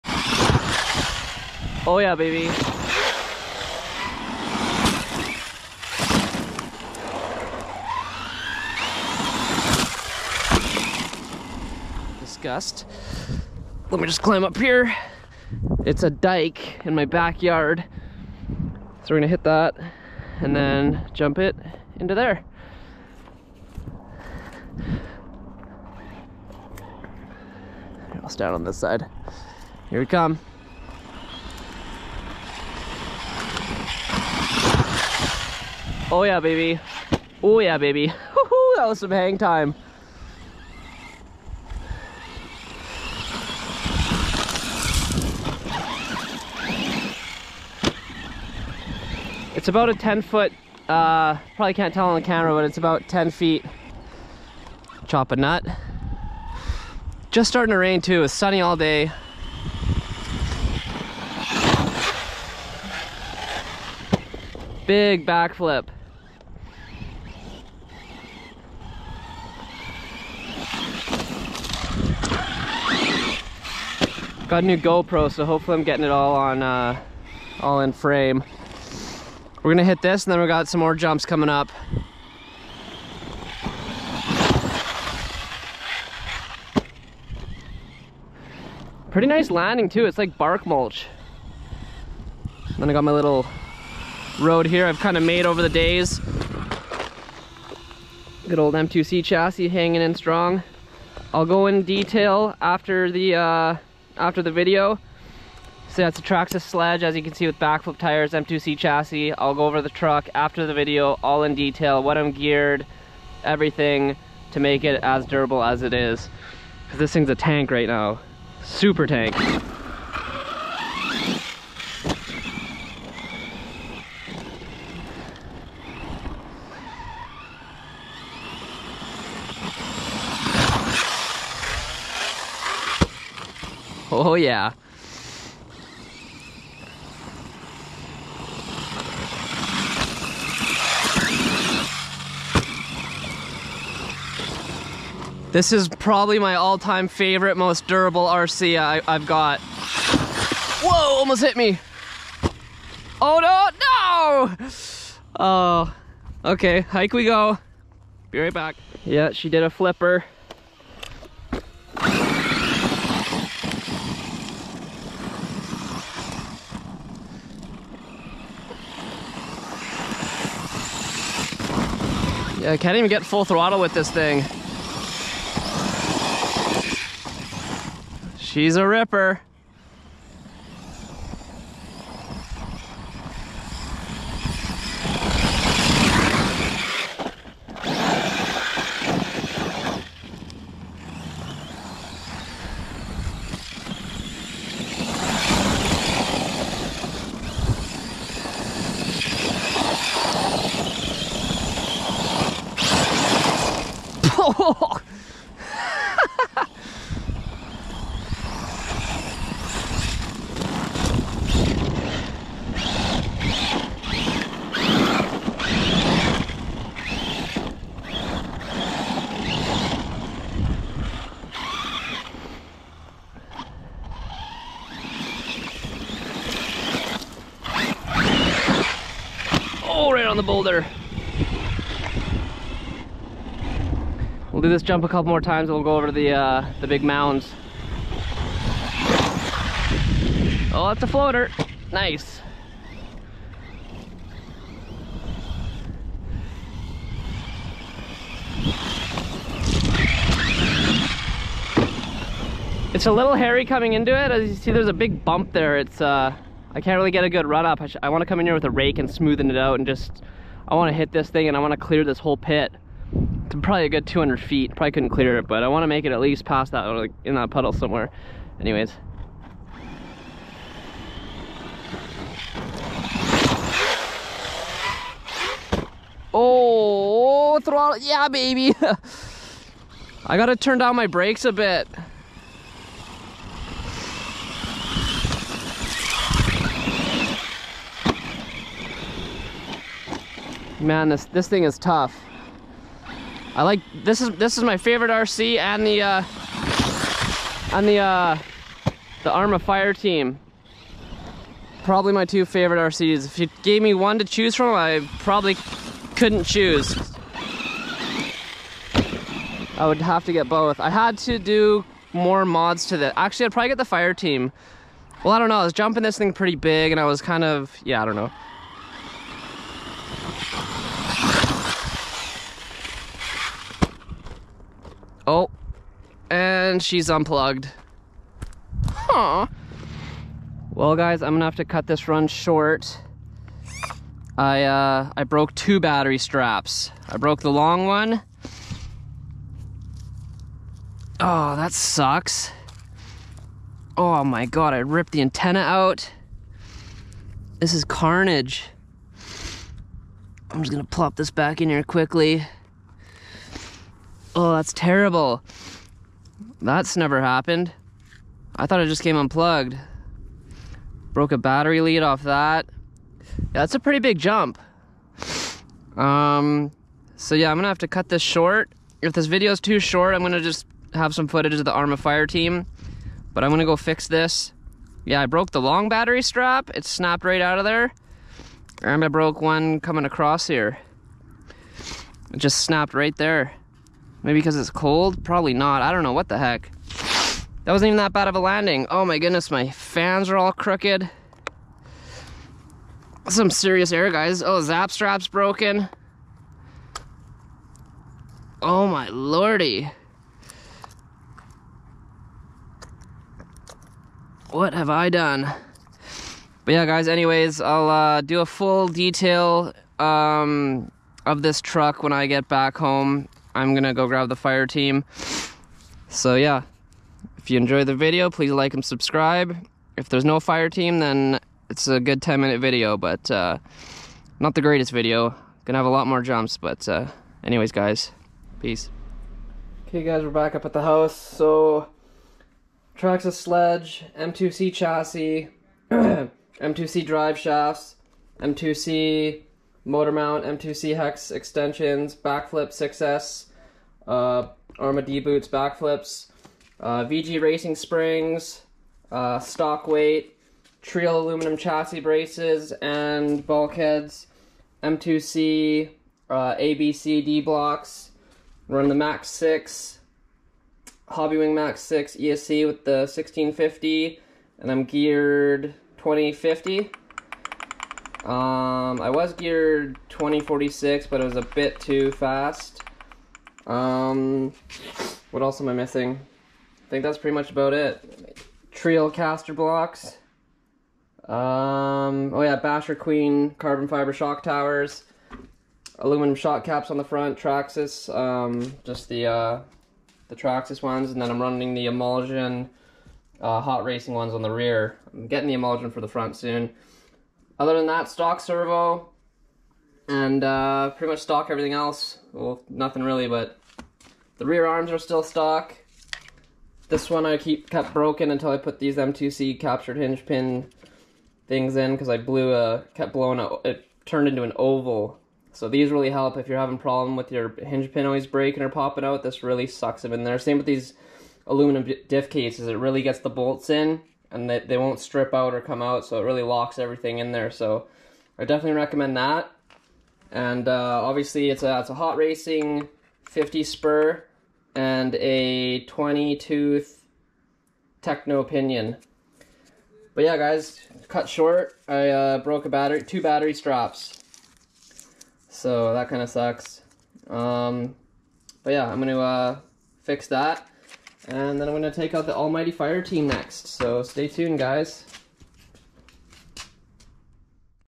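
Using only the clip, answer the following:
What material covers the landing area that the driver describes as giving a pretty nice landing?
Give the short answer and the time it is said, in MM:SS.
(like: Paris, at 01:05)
Bark mulch, at 01:30.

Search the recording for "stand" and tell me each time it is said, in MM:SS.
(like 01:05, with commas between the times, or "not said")
00:28.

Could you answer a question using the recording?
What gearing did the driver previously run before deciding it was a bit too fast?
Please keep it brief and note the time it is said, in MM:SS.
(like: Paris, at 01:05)
20/46, at 07:50.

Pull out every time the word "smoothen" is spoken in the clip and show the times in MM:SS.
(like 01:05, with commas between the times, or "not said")
04:19.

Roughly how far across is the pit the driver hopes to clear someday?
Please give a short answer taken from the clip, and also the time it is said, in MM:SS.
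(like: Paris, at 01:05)
200 feet, at 04:24.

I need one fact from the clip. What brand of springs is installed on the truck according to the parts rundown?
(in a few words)
VG Racing.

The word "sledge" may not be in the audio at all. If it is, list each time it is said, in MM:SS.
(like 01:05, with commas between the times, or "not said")
01:46, 07:13.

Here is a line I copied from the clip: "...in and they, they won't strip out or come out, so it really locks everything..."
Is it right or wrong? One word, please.
right.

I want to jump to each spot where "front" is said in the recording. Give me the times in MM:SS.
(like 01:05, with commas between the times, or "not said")
08:07, 08:16.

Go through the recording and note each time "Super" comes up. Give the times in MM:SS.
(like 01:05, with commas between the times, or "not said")
01:58.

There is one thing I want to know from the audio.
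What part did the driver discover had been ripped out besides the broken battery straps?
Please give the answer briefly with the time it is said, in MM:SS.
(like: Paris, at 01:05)
The antenna, at 05:45.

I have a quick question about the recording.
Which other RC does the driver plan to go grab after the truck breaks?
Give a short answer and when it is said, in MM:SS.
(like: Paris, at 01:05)
Arrma Fireteam, at 06:11.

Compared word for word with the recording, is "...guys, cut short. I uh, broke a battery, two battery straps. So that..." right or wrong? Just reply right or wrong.
right.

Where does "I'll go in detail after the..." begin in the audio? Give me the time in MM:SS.
01:41.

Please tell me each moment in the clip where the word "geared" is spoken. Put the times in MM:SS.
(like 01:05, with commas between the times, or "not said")
01:52, 07:44, 07:49.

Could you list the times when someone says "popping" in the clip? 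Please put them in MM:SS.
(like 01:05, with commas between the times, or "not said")
08:38.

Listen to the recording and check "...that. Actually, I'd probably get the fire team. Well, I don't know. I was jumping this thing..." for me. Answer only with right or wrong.
right.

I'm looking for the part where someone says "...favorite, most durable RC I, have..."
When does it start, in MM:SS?
02:27.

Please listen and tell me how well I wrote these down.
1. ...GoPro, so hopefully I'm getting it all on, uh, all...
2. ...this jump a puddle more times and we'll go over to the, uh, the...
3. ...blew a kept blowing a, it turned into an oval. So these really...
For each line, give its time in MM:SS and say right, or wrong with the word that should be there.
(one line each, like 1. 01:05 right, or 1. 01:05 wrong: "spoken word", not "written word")
1. 01:14 right
2. 03:54 wrong: "couple", not "puddle"
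3. 08:32 right.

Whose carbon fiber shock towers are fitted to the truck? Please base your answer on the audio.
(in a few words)
BasherQueen.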